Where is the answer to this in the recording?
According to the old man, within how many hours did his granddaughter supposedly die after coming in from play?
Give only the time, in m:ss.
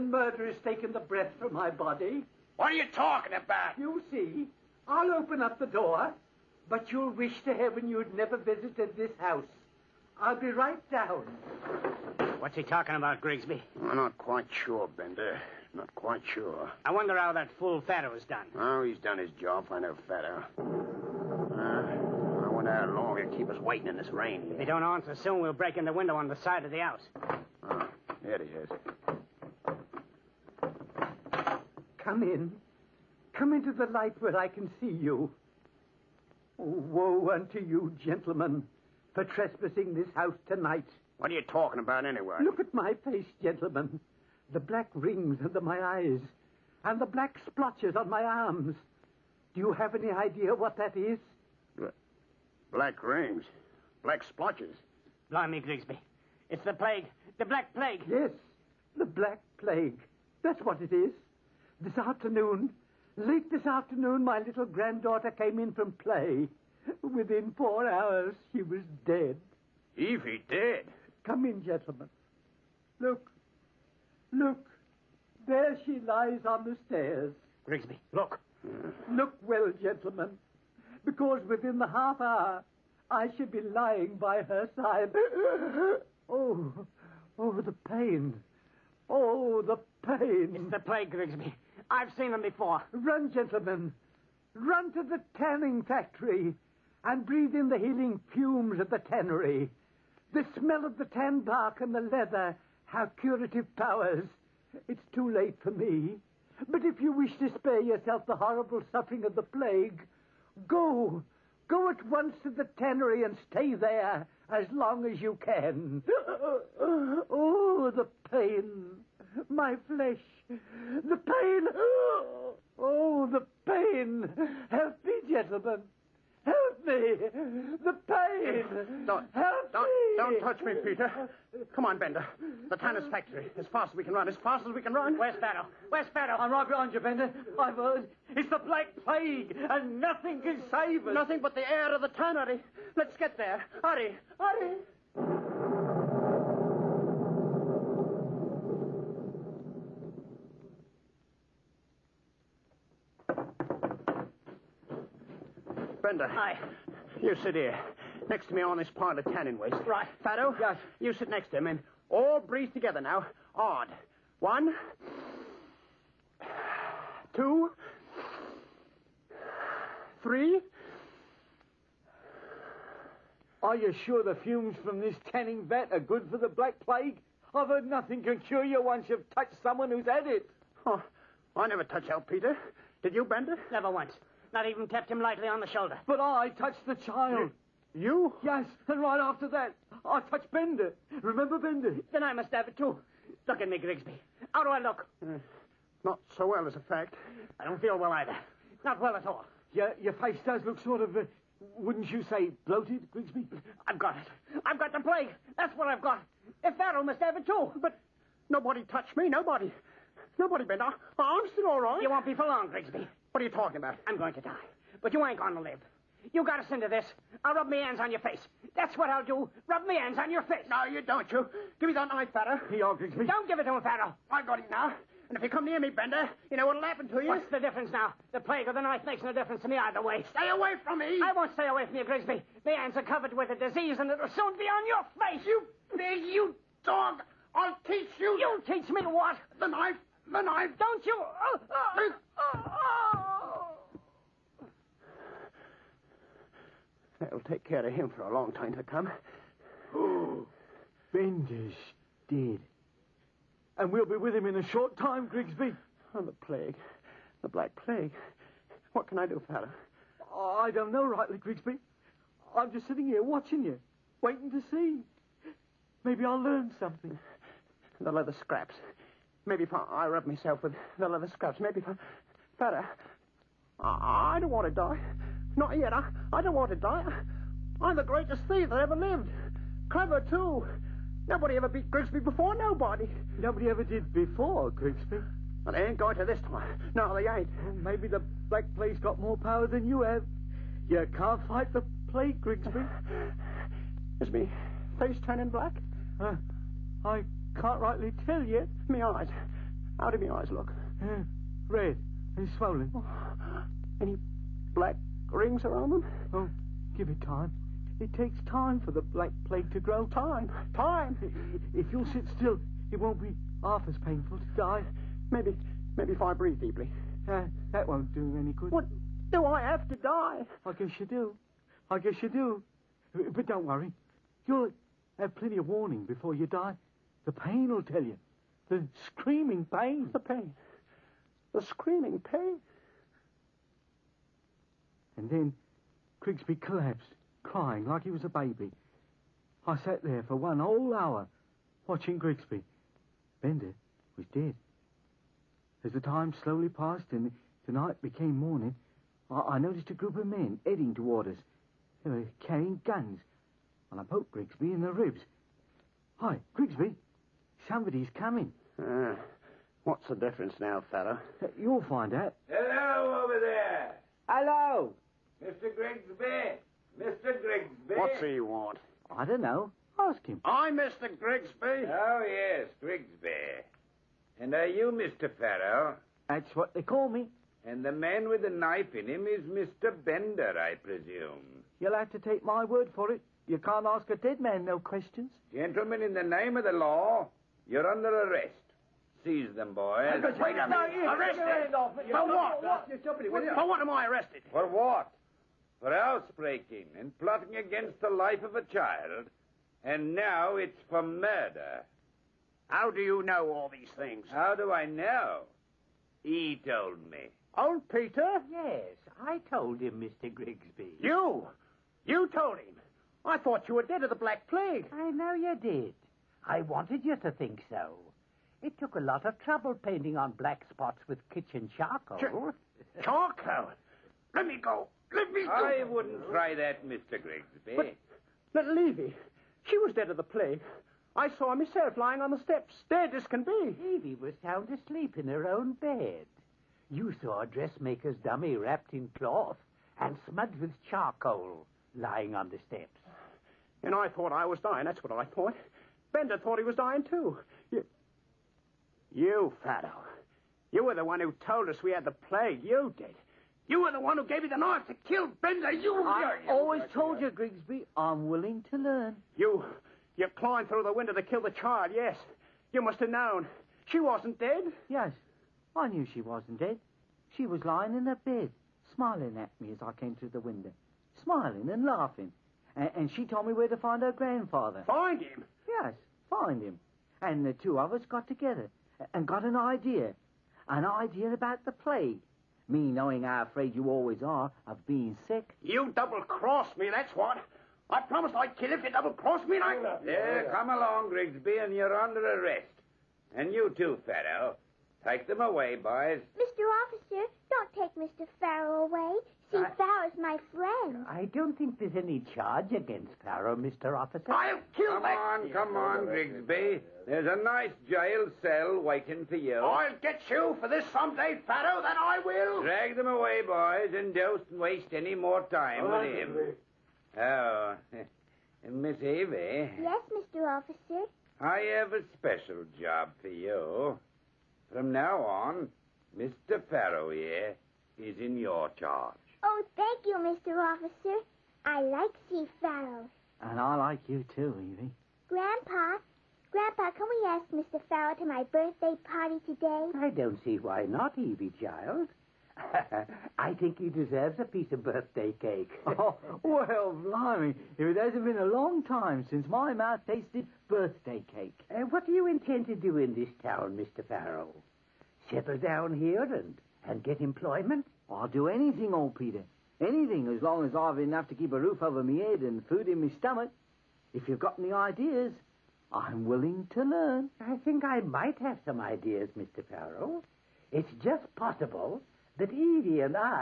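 1:07.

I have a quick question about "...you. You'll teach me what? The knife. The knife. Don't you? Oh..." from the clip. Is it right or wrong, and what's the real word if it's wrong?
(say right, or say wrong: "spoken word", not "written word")
right.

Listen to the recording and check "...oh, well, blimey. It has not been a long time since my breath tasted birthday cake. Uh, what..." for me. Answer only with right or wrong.
wrong.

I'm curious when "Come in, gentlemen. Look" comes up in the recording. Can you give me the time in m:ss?
1:11.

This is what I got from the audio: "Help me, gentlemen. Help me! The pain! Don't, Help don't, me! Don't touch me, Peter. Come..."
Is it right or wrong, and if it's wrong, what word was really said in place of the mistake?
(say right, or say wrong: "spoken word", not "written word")
right.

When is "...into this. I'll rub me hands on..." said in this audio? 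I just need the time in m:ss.
3:36.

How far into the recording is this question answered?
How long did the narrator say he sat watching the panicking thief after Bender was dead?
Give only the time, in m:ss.
5:40.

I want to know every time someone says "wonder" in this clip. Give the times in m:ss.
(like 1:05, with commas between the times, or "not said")
0:16, 0:22.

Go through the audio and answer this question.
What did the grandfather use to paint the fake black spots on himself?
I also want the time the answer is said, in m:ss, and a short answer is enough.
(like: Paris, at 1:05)
Kitchen charcoal, at 7:01.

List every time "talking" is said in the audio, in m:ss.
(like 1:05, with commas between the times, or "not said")
0:02, 0:12, 0:41, 3:33.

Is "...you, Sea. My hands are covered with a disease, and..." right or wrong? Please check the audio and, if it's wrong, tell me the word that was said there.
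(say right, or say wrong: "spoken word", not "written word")
wrong: "Grigsby", not "Sea".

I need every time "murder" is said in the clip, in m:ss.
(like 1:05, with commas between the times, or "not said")
0:00, 6:41.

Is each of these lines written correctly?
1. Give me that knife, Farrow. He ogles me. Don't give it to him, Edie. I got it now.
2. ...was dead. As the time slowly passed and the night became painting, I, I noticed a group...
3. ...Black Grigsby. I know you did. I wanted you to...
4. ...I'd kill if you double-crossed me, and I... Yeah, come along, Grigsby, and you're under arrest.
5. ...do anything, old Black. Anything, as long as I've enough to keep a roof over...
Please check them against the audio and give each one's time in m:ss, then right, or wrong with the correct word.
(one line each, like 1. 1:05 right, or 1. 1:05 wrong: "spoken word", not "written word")
1. 3:41 wrong: "Farrow", not "Edie"
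2. 5:44 wrong: "morning", not "painting"
3. 6:54 wrong: "Plague", not "Grigsby"
4. 8:08 right
5. 9:18 wrong: "Peter", not "Black".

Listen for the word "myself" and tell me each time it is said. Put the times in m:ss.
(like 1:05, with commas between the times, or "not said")
4:30, 7:11.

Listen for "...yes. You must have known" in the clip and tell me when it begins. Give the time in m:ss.
7:41.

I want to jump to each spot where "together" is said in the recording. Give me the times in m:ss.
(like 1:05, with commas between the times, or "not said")
2:42, 7:58.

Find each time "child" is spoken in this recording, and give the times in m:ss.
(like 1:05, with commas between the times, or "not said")
3:07, 6:38, 7:41, 9:01.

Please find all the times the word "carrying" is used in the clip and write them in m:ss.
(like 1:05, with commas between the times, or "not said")
5:52.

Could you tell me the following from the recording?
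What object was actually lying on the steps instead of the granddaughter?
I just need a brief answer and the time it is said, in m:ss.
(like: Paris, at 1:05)
A dressmaker's dummy, at 7:17.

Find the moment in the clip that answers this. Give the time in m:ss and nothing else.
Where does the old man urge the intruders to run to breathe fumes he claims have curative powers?
1:35.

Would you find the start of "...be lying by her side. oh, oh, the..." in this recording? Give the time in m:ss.
1:23.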